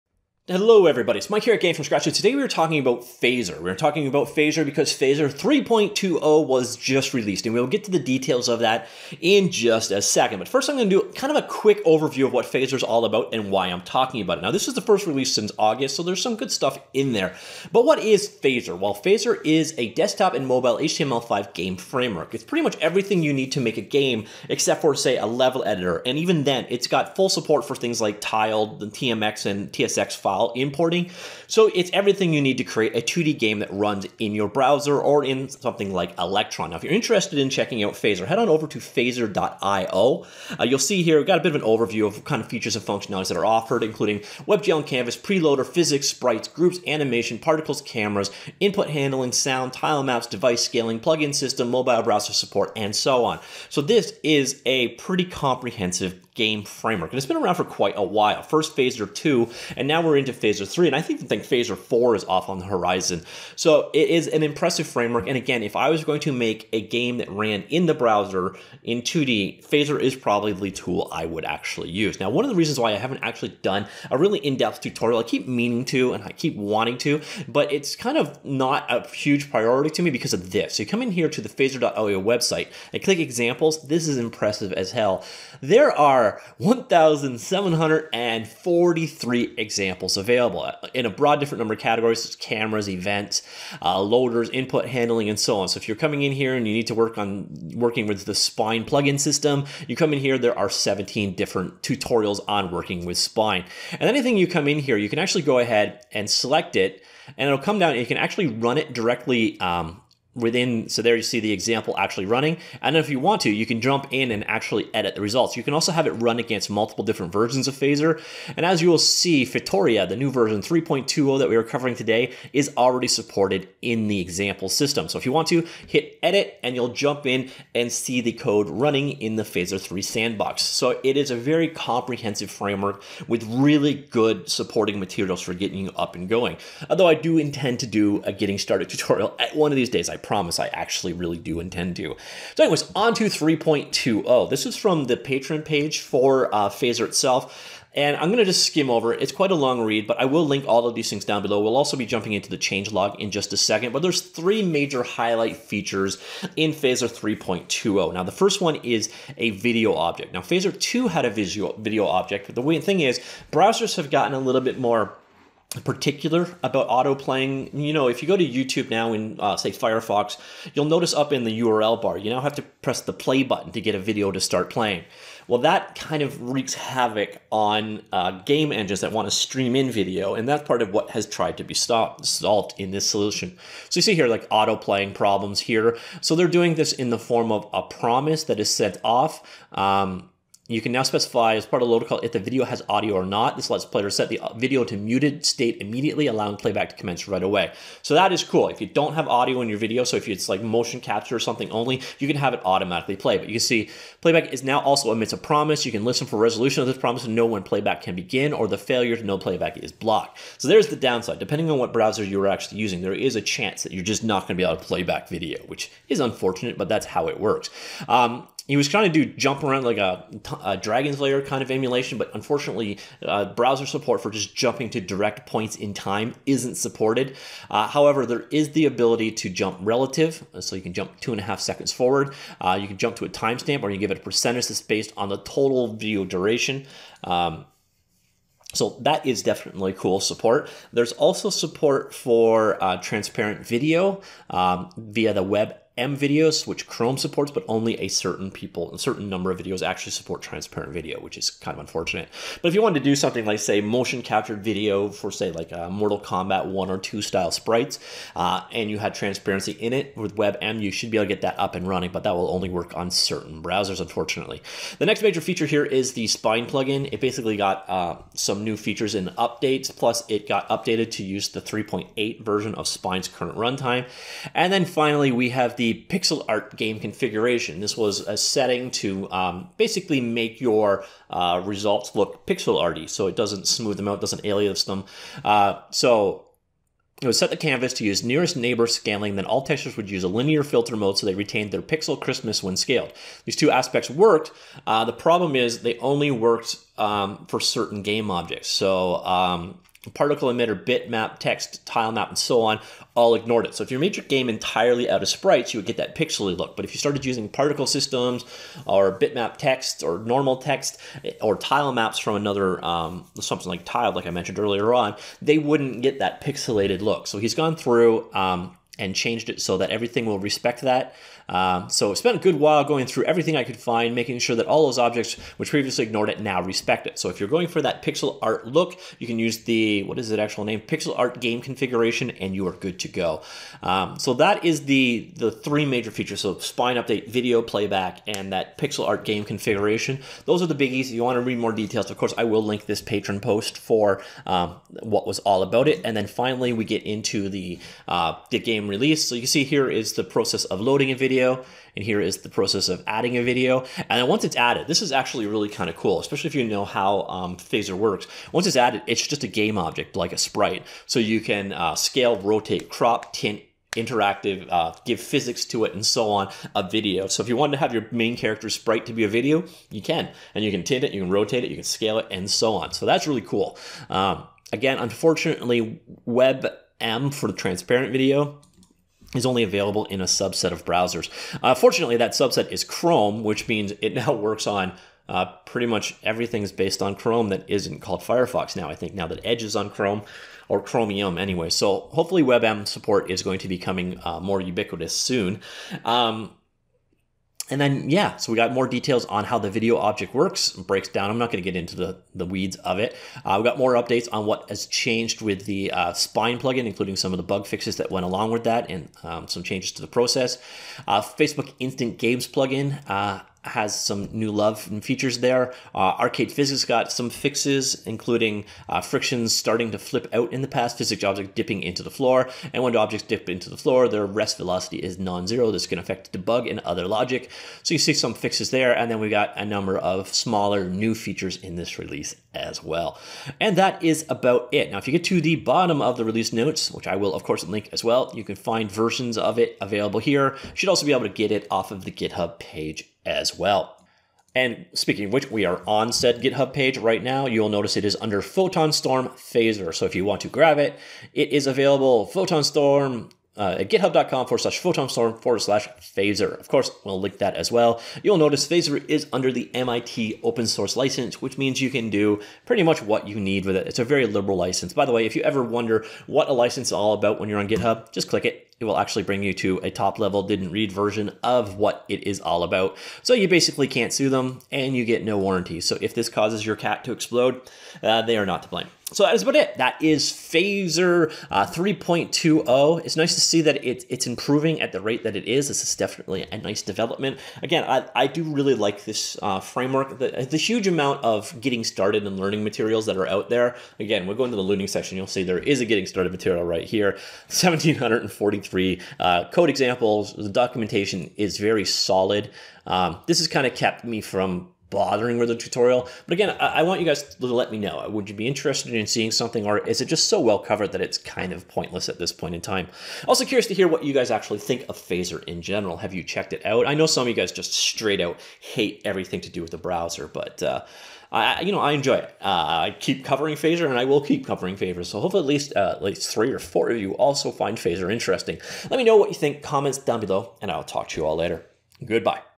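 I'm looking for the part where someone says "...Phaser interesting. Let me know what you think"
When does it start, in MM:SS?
08:47.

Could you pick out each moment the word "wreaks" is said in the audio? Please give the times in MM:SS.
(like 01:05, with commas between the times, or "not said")
02:56.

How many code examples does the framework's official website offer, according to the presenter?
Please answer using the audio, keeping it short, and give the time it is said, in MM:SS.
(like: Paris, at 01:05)
1,743, at 01:26.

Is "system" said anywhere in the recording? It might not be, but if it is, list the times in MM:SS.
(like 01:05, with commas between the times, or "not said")
00:51, 01:39, 02:04, 05:07.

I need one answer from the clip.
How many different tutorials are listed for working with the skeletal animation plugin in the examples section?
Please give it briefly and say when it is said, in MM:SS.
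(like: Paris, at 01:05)
17, at 01:40.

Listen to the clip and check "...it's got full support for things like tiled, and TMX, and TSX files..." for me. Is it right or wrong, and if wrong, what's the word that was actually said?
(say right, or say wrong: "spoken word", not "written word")
right.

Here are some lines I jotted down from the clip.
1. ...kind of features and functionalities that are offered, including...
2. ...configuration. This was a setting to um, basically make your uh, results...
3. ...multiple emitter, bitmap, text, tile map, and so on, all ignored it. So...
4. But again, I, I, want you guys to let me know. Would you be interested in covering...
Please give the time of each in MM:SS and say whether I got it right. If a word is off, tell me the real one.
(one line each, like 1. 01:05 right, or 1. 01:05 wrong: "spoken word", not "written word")
1. 00:42 right
2. 04:36 right
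3. 05:00 wrong: "particle", not "multiple"
4. 08:26 wrong: "seeing", not "covering".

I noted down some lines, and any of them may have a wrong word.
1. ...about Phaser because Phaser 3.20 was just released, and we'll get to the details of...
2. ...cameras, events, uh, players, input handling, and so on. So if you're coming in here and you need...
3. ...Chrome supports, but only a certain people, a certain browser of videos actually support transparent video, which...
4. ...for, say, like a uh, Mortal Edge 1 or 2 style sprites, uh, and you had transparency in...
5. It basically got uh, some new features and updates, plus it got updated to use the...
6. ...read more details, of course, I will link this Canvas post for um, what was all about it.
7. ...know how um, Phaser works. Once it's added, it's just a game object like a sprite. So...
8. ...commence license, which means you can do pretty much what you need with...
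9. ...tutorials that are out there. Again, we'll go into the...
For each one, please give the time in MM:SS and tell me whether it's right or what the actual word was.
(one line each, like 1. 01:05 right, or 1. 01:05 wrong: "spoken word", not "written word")
1. 00:04 right
2. 01:32 wrong: "loaders", not "players"
3. 04:06 wrong: "number", not "browser"
4. 04:15 wrong: "Kombat", not "Edge"
5. 04:27 right
6. 05:41 wrong: "Patreon", not "Canvas"
7. 05:56 right
8. 07:40 wrong: "source", not "commence"
9. 08:12 wrong: "materials", not "tutorials".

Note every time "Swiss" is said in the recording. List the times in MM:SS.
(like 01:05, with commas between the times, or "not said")
not said.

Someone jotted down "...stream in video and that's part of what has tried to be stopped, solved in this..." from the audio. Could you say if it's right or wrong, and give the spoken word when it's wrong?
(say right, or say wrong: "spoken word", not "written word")
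right.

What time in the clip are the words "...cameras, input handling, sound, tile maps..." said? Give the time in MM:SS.
00:47.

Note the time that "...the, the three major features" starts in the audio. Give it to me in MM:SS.
05:34.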